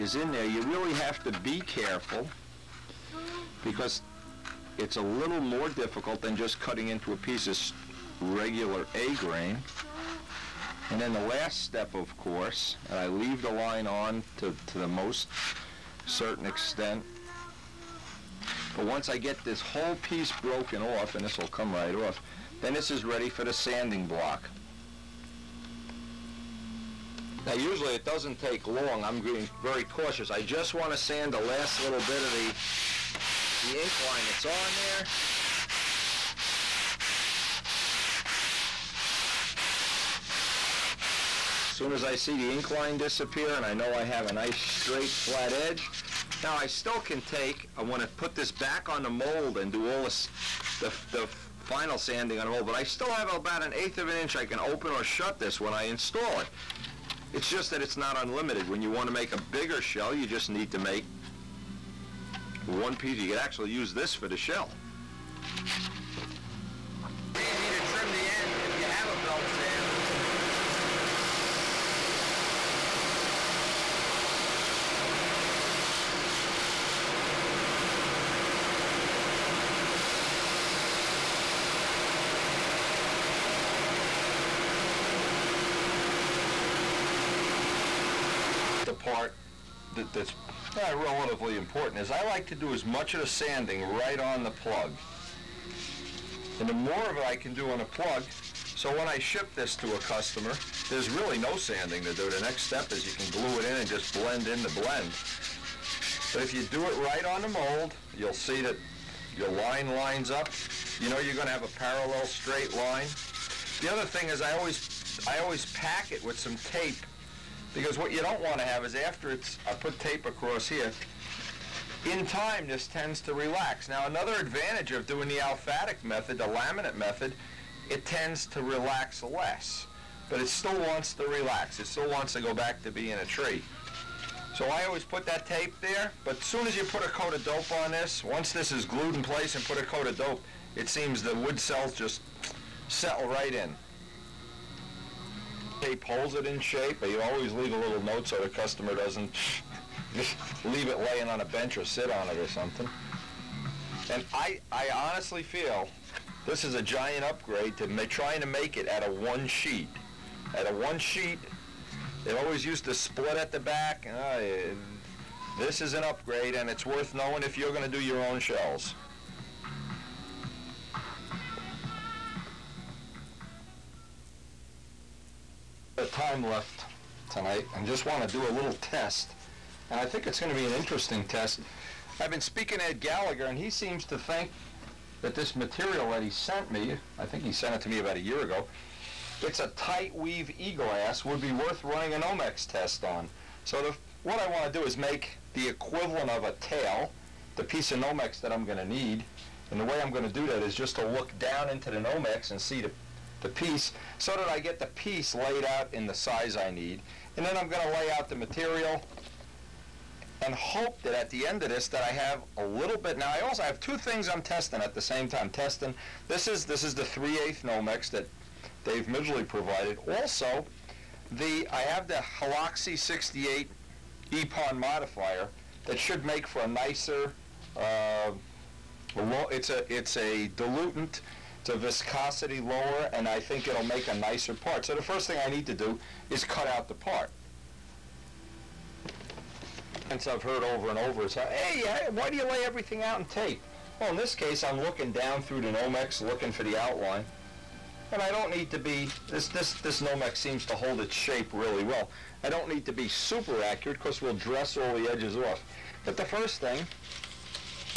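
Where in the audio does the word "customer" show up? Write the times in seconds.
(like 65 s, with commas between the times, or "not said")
100 s, 148 s.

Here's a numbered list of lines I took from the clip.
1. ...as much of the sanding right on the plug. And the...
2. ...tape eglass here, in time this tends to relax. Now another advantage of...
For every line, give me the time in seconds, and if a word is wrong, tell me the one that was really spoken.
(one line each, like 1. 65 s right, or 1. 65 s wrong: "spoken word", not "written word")
1. 92 s right
2. 120 s wrong: "across", not "eglass".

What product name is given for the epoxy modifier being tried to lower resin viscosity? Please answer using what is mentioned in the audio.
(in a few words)
Heloxy 68.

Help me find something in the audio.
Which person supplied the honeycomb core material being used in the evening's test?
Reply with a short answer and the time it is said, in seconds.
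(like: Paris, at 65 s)
Dave Midgley, at 218 s.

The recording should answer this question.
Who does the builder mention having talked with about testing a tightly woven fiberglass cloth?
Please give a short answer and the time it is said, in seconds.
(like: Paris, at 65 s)
Ed Gallagher, at 182 s.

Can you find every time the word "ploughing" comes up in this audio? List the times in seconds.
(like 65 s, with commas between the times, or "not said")
not said.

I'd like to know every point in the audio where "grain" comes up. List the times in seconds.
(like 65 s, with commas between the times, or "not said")
9 s.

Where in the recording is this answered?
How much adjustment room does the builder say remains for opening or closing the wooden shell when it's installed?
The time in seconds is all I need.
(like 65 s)
53 s.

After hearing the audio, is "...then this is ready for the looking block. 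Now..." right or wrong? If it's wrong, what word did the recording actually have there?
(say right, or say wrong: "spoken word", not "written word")
wrong: "sanding", not "looking".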